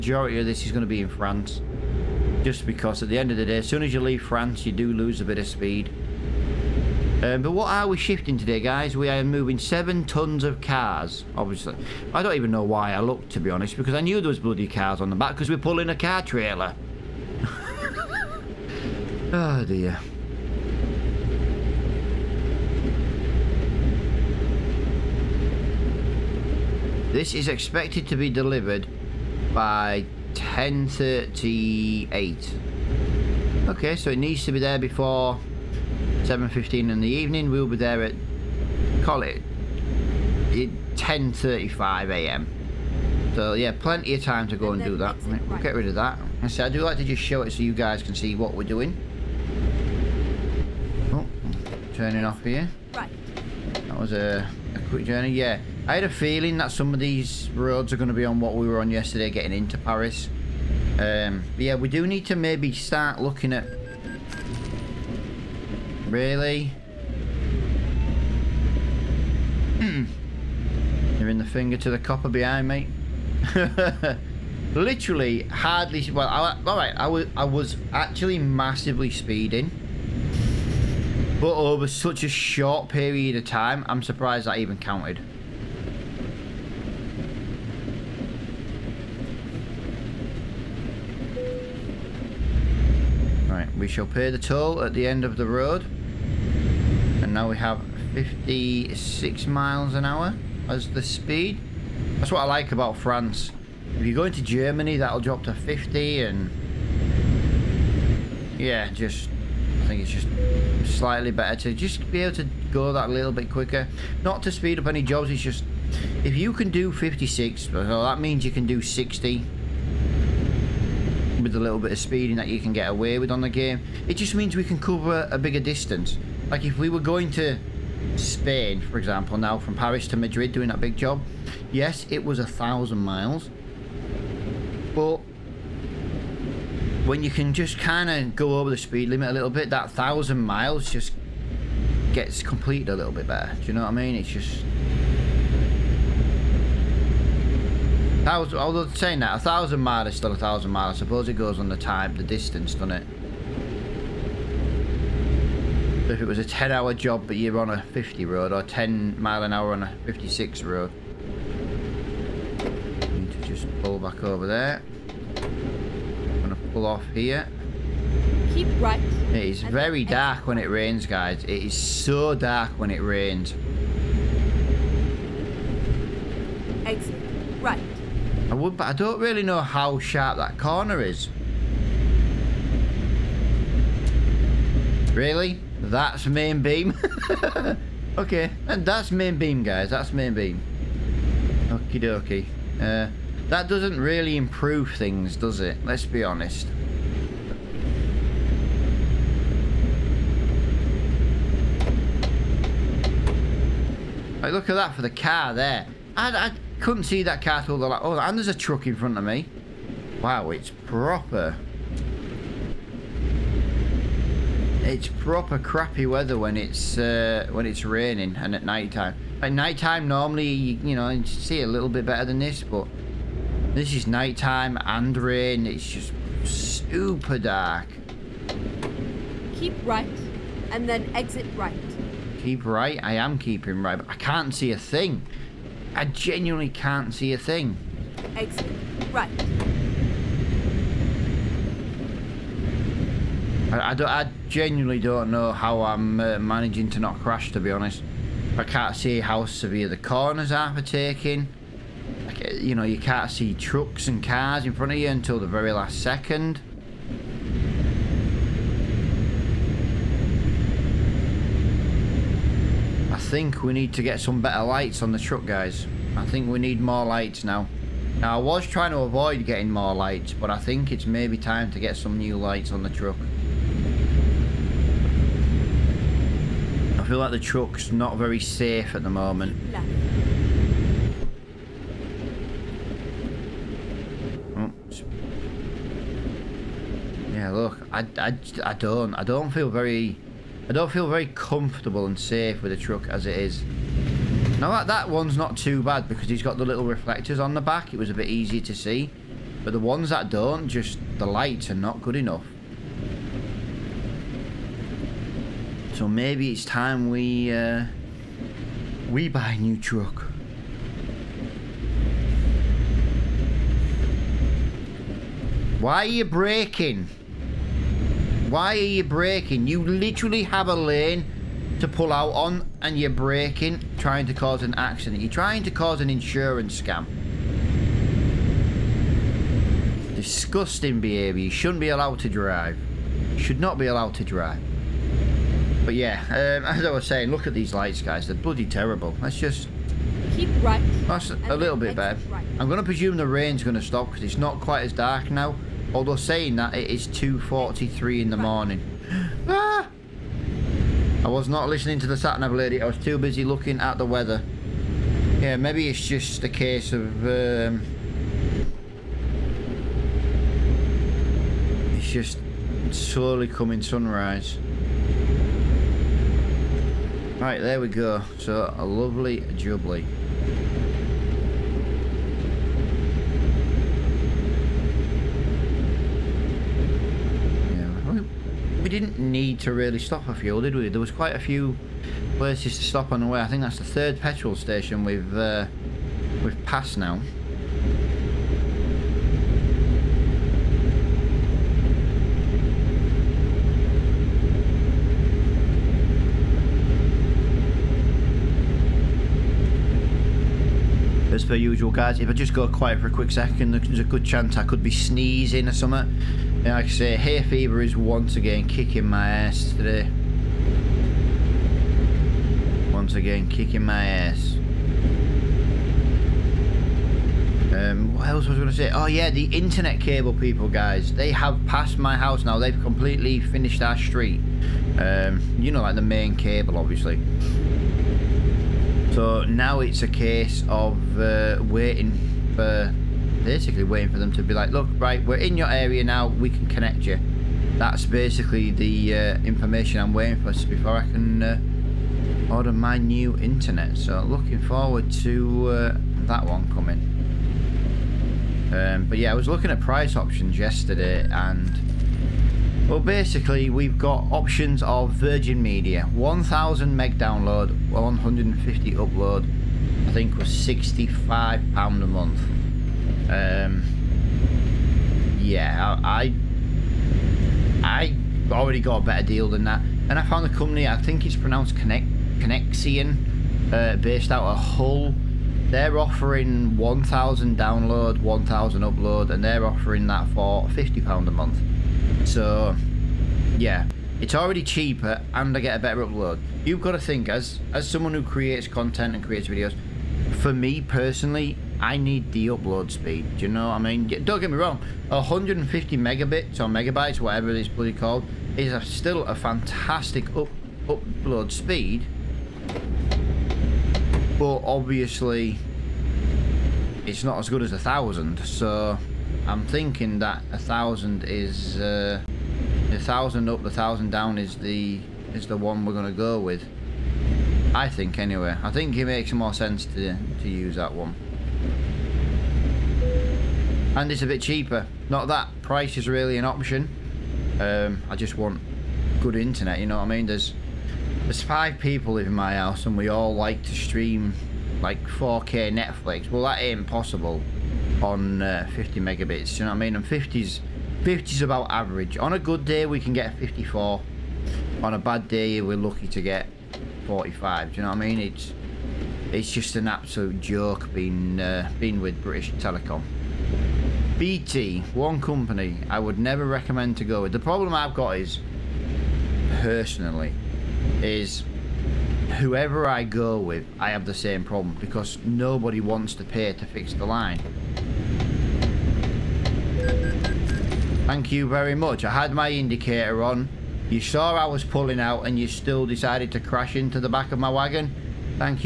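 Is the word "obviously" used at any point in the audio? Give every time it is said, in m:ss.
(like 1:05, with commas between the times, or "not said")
0:11, 7:06, 8:24.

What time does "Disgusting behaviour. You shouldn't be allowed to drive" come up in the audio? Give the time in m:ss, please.
5:30.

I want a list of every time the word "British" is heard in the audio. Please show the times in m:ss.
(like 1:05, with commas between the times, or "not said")
9:12.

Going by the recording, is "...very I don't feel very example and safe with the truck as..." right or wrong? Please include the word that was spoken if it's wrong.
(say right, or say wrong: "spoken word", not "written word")
wrong: "comfortable", not "example".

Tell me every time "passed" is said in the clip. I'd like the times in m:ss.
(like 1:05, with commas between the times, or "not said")
6:26, 7:01.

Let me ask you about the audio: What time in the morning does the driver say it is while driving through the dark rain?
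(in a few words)
2:43.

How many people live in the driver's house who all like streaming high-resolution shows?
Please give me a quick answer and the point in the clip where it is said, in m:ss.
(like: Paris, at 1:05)
5, at 8:51.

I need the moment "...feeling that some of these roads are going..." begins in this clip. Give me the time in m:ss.
0:56.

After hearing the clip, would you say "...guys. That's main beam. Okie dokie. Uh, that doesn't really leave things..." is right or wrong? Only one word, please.
wrong.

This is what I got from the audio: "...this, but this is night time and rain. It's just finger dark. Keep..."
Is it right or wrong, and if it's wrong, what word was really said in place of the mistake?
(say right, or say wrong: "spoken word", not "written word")
wrong: "super", not "finger".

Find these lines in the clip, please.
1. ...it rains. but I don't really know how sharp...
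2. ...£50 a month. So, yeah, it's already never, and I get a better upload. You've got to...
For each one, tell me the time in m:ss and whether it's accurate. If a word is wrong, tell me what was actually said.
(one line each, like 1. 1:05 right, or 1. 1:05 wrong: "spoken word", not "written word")
1. 2:52 right
2. 8:00 wrong: "cheaper", not "never".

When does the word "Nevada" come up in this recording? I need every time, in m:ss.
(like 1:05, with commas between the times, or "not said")
not said.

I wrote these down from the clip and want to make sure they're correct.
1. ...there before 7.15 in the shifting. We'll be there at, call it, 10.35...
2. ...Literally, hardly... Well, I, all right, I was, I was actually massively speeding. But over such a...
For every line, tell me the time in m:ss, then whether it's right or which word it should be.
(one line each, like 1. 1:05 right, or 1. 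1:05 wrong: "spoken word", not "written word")
1. 0:34 wrong: "evening", not "shifting"
2. 1:14 right.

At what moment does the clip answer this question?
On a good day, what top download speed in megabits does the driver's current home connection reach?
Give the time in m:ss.
9:03.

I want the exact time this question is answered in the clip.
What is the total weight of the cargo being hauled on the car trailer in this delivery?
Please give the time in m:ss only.
0:09.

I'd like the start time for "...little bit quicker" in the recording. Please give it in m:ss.
1:53.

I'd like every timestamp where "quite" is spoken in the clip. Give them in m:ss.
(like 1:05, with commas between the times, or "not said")
5:44, 6:21.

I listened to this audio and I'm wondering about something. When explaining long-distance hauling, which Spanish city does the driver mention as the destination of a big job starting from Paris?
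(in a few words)
Madrid.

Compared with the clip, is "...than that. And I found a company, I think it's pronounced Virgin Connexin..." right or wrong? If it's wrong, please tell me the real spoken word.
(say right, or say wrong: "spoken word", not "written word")
wrong: "Connect", not "Virgin".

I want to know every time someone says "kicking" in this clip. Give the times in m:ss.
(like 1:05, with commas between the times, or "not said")
6:48, 6:53.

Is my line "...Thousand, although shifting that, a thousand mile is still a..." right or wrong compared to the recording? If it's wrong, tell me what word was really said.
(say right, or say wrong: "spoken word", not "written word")
wrong: "saying", not "shifting".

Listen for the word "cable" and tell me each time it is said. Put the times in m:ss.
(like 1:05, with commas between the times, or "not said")
7:00, 7:06.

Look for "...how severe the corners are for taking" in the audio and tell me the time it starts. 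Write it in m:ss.
4:09.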